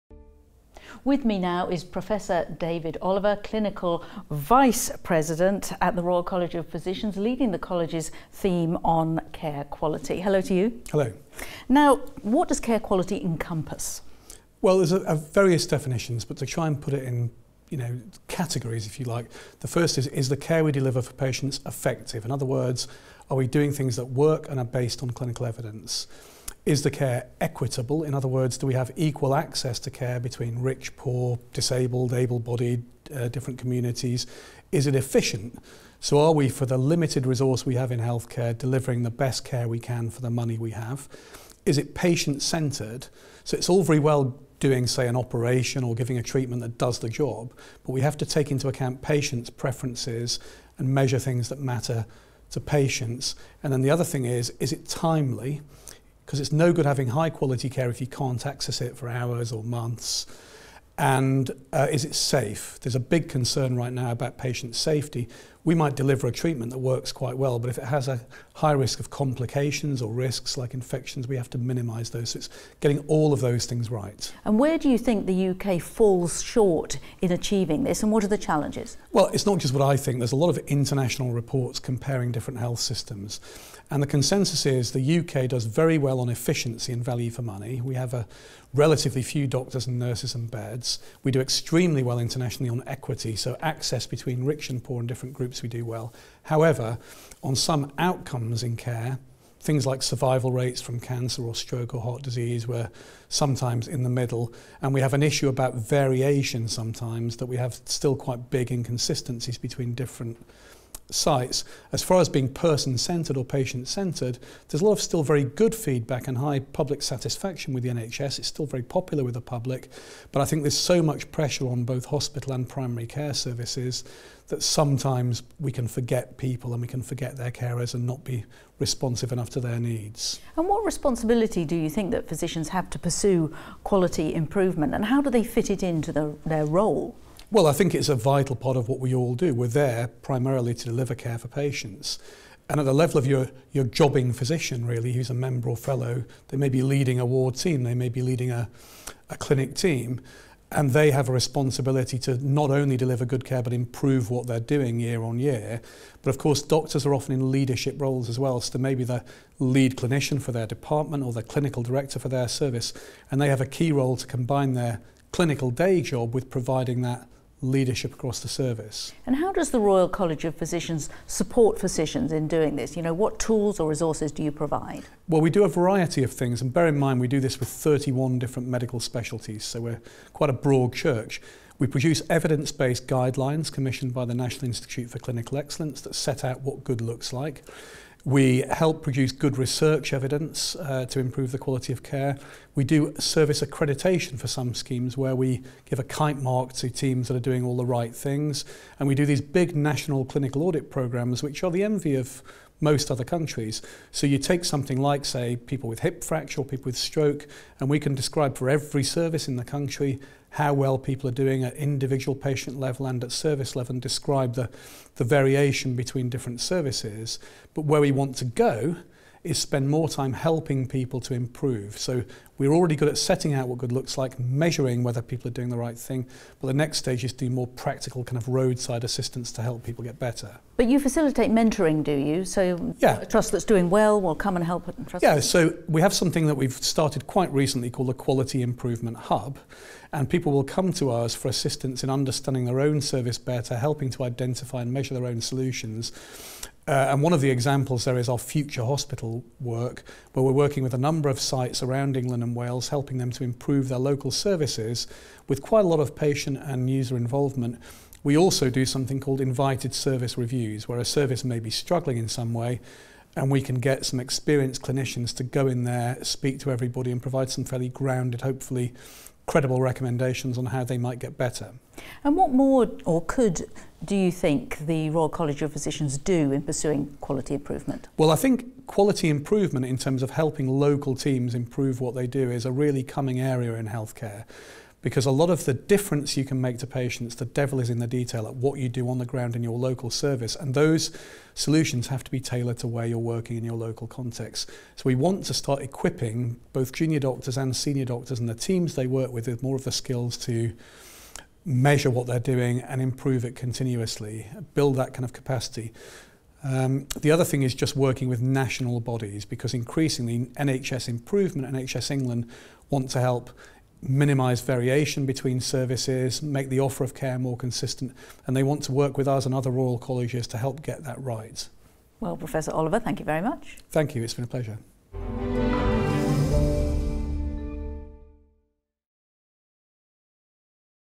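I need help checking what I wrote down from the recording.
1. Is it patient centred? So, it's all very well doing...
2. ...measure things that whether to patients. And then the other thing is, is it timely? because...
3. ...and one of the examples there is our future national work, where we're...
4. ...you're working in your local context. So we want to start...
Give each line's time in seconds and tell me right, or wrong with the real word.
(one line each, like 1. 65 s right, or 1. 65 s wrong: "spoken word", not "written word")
1. 41 s right
2. 50 s wrong: "matter", not "whether"
3. 247 s wrong: "hospital", not "national"
4. 293 s right.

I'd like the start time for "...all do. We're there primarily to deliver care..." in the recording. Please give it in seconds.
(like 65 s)
139 s.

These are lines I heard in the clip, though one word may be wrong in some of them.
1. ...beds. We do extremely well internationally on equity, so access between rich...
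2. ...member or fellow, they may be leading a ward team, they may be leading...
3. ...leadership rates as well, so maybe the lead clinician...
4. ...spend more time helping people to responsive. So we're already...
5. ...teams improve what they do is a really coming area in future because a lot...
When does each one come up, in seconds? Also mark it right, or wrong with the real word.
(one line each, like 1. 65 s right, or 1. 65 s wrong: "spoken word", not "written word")
1. 90 s right
2. 145 s right
3. 157 s wrong: "roles", not "rates"
4. 219 s wrong: "improve", not "responsive"
5. 281 s wrong: "healthcare", not "future".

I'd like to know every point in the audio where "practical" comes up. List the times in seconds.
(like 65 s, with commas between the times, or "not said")
227 s.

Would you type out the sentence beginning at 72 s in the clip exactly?
So it's getting all of those things right.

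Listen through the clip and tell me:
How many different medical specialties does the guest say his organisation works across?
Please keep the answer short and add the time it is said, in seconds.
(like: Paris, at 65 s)
31, at 177 s.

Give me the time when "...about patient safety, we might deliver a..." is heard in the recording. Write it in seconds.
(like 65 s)
64 s.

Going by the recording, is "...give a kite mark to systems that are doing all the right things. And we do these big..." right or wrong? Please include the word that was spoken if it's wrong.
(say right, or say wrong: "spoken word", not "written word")
wrong: "teams", not "systems".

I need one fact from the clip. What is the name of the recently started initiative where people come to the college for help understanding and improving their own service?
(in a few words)
Quality Improvement Hub.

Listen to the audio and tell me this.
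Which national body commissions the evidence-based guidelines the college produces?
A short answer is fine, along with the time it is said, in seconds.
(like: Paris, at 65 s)
National Institute for Clinical Excellence, at 184 s.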